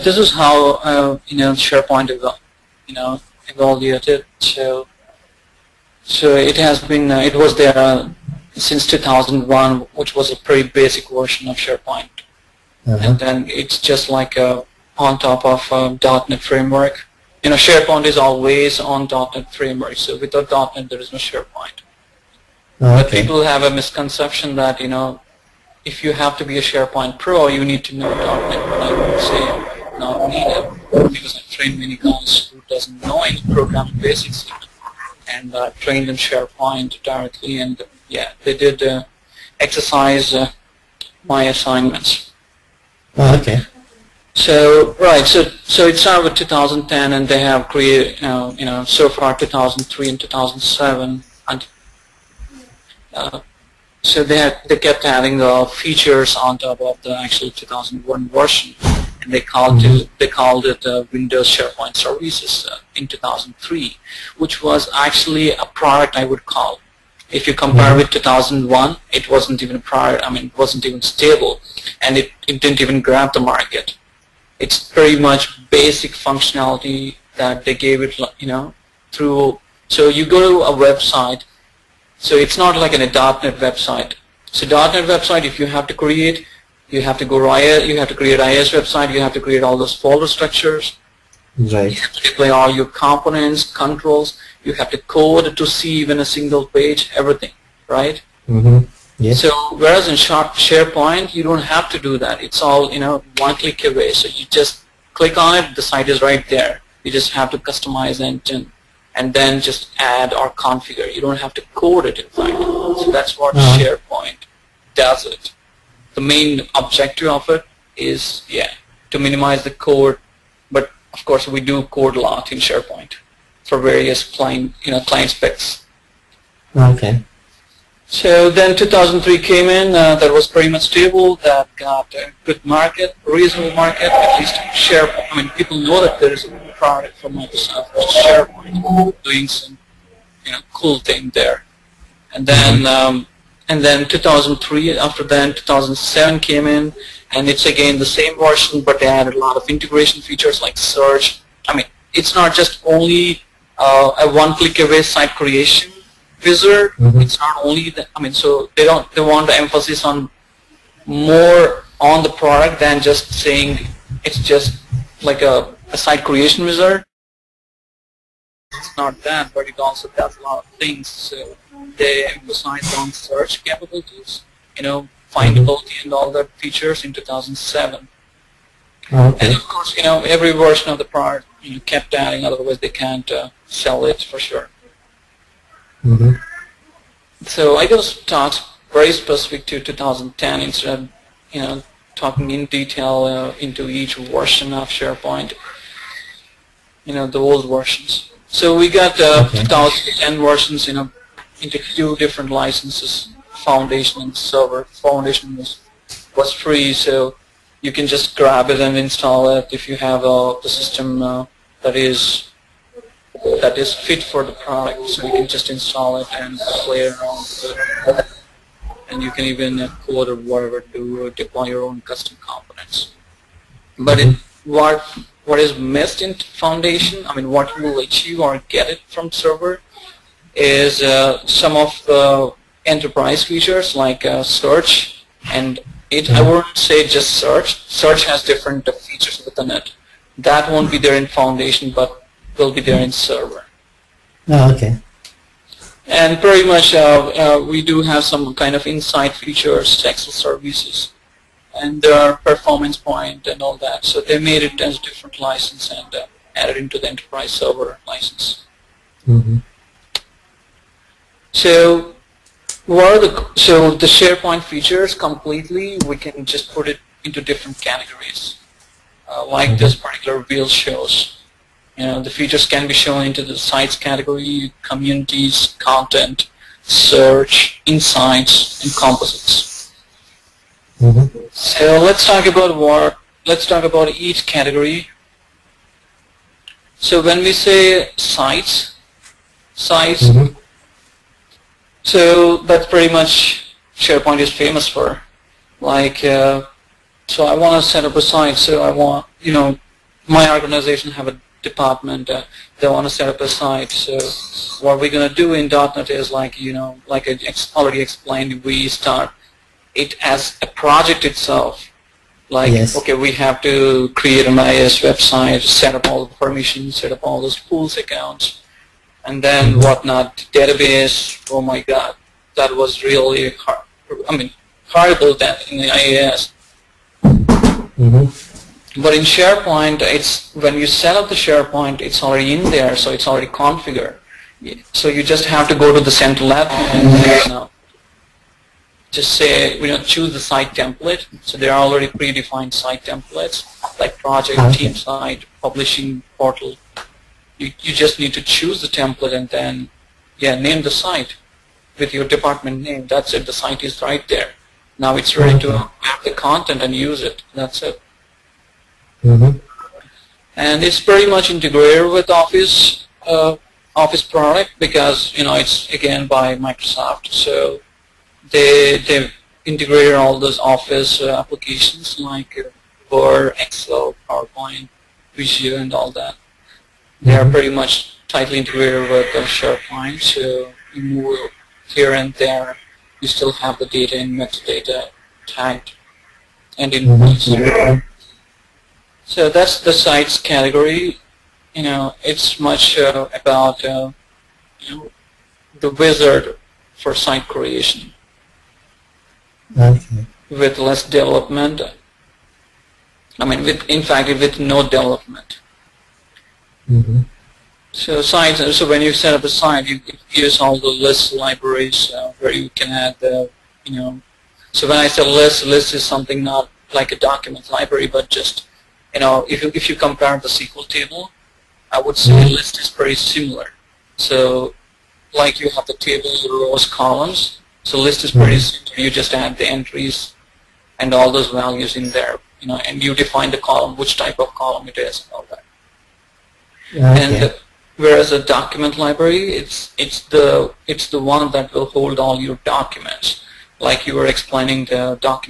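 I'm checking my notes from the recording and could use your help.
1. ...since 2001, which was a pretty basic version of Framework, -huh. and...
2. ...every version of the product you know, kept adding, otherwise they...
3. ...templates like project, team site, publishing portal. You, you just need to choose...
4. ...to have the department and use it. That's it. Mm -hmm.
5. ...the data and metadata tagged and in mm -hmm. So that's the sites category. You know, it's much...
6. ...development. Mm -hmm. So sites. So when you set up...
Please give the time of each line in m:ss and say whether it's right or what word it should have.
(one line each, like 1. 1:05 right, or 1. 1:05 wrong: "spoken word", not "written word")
1. 0:08 wrong: "SharePoint", not "Framework"
2. 3:00 right
3. 5:43 right
4. 5:55 wrong: "content", not "department"
5. 6:23 right
6. 6:44 right.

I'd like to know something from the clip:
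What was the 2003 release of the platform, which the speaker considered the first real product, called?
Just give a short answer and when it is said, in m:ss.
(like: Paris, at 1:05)
Windows SharePoint Services, at 1:01.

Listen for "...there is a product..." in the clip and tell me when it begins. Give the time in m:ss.
2:16.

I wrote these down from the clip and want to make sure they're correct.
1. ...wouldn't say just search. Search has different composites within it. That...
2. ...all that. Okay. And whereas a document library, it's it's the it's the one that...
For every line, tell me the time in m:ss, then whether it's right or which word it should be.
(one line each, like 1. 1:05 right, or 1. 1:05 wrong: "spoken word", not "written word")
1. 3:56 wrong: "features", not "composites"
2. 7:15 right.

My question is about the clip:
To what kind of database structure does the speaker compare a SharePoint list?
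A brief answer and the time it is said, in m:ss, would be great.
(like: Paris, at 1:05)
SQL table, at 7:00.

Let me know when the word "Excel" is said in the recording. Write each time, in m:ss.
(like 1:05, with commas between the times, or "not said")
4:10, 6:13.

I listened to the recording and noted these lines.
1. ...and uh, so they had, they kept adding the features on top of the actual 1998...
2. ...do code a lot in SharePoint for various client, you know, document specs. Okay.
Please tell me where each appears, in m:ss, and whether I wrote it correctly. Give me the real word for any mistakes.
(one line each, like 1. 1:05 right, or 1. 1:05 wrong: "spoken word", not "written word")
1. 0:51 wrong: "2001", not "1998"
2. 2:01 wrong: "client", not "document".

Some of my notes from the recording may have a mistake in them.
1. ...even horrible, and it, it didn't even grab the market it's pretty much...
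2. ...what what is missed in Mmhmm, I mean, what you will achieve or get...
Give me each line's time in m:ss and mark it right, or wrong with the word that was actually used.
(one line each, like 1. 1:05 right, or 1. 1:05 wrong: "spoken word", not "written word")
1. 1:10 wrong: "stable", not "horrible"
2. 3:44 wrong: "Foundation", not "Mmhmm".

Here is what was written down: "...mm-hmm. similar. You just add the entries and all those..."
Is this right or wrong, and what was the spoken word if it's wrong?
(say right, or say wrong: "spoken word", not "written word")
right.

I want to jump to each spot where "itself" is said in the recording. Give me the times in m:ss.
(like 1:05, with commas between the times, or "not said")
5:11.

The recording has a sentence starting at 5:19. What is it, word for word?
whatnot, database, oh my god, that was really hard, I mean, horrible that in the IIS.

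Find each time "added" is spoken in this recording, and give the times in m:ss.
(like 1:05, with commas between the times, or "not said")
2:29, 4:16.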